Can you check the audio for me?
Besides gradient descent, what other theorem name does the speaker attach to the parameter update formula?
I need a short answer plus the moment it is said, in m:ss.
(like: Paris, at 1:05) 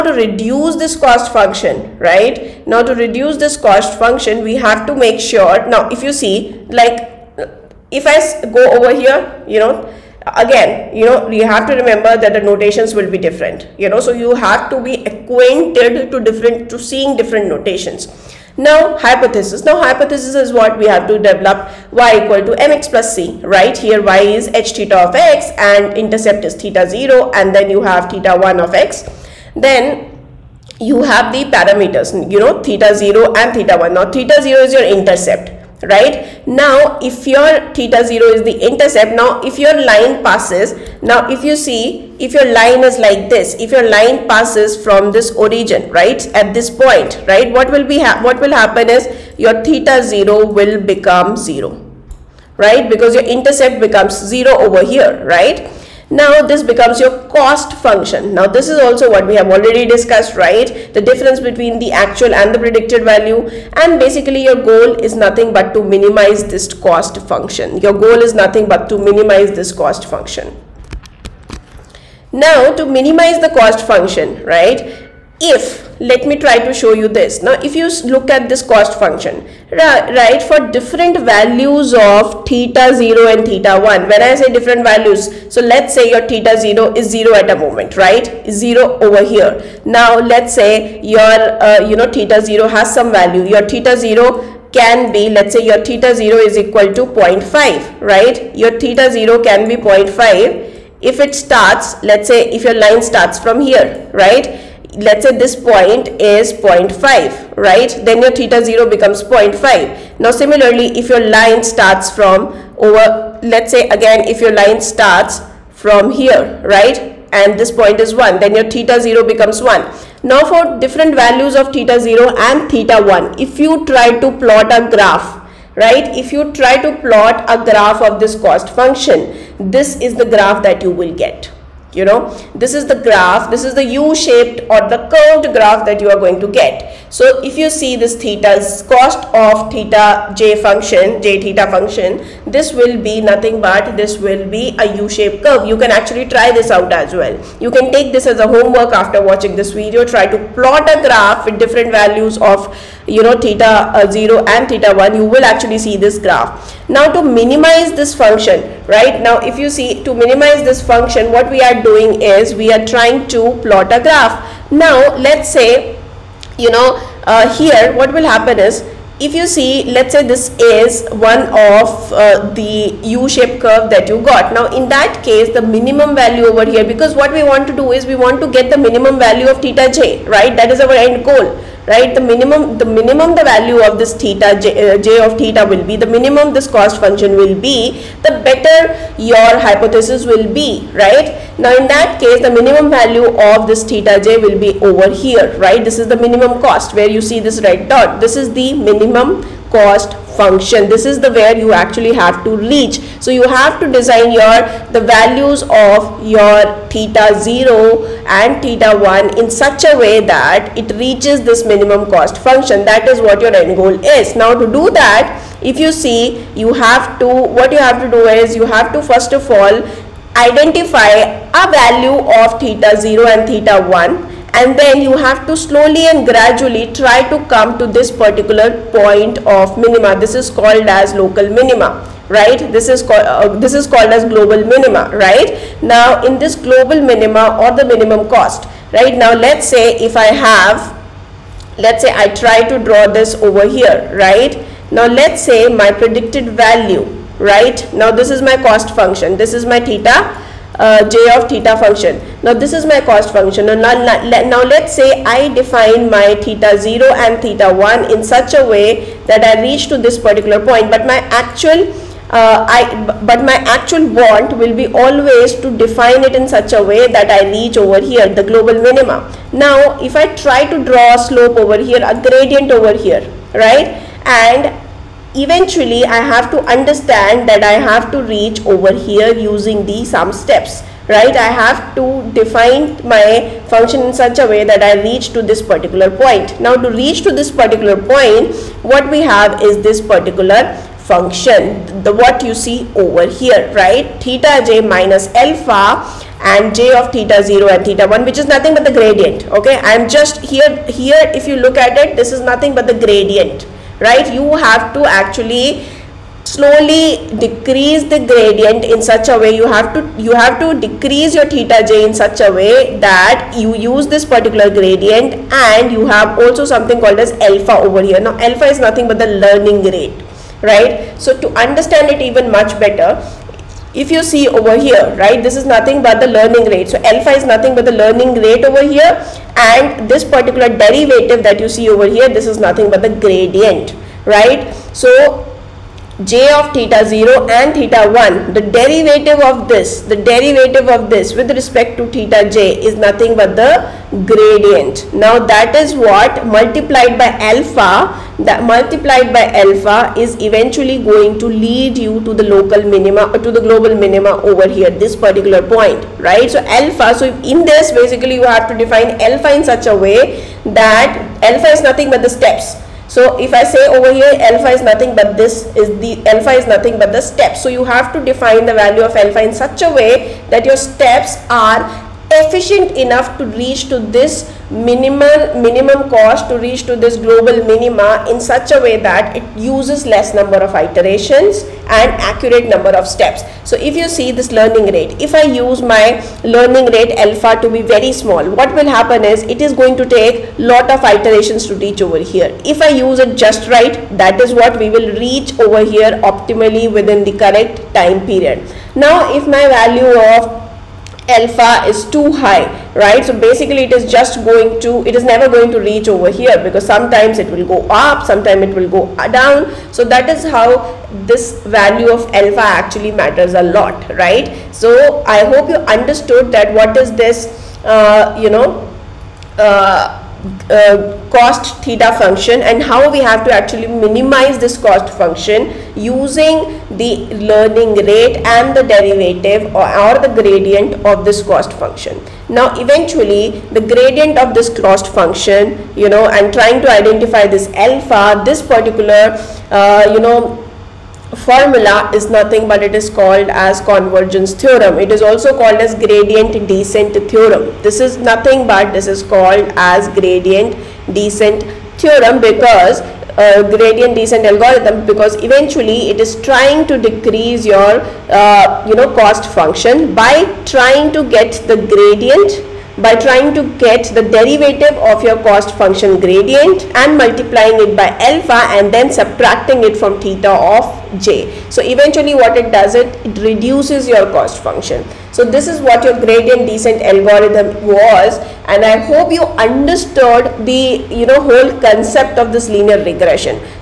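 Convergence theorem, at 7:23.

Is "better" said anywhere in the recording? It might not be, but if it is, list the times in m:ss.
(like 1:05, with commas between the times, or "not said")
3:08, 5:22.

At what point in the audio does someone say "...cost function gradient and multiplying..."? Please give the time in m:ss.
7:45.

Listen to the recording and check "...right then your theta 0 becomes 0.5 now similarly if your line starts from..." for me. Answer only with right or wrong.
right.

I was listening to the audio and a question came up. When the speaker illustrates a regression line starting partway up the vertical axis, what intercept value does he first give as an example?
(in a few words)
0.5.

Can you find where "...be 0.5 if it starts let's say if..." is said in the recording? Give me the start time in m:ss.
1:39.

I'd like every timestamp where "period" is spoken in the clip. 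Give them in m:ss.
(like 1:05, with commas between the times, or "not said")
6:38.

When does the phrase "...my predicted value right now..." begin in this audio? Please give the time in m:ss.
4:05.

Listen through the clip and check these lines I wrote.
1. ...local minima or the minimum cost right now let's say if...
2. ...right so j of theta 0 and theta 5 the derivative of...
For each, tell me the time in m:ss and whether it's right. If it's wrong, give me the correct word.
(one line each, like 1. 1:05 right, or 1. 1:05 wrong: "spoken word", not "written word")
1. 3:56 wrong: "global", not "local"
2. 5:34 wrong: "1", not "5".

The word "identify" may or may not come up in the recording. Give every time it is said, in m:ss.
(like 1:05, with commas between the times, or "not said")
3:40, 7:16.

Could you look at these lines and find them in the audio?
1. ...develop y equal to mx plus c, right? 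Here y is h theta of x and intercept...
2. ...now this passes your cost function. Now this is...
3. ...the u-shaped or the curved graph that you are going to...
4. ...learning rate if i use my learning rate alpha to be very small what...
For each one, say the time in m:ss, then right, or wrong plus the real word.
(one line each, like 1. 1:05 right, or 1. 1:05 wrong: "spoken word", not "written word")
1. 0:21 right
2. 0:56 wrong: "becomes", not "passes"
3. 2:13 right
4. 6:24 right.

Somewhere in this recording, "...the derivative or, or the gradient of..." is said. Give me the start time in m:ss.
7:08.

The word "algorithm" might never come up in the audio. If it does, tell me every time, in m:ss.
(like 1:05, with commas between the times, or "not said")
7:34, 7:57.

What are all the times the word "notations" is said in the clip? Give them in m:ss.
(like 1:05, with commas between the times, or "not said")
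0:12, 0:17.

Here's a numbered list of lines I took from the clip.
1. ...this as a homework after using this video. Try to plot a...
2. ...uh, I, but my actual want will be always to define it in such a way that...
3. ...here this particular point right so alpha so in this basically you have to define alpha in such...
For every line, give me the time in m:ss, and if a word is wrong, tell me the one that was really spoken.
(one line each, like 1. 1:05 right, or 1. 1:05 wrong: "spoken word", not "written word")
1. 2:28 wrong: "watching", not "using"
2. 4:22 right
3. 5:54 right.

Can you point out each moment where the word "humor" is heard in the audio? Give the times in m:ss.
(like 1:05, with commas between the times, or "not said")
not said.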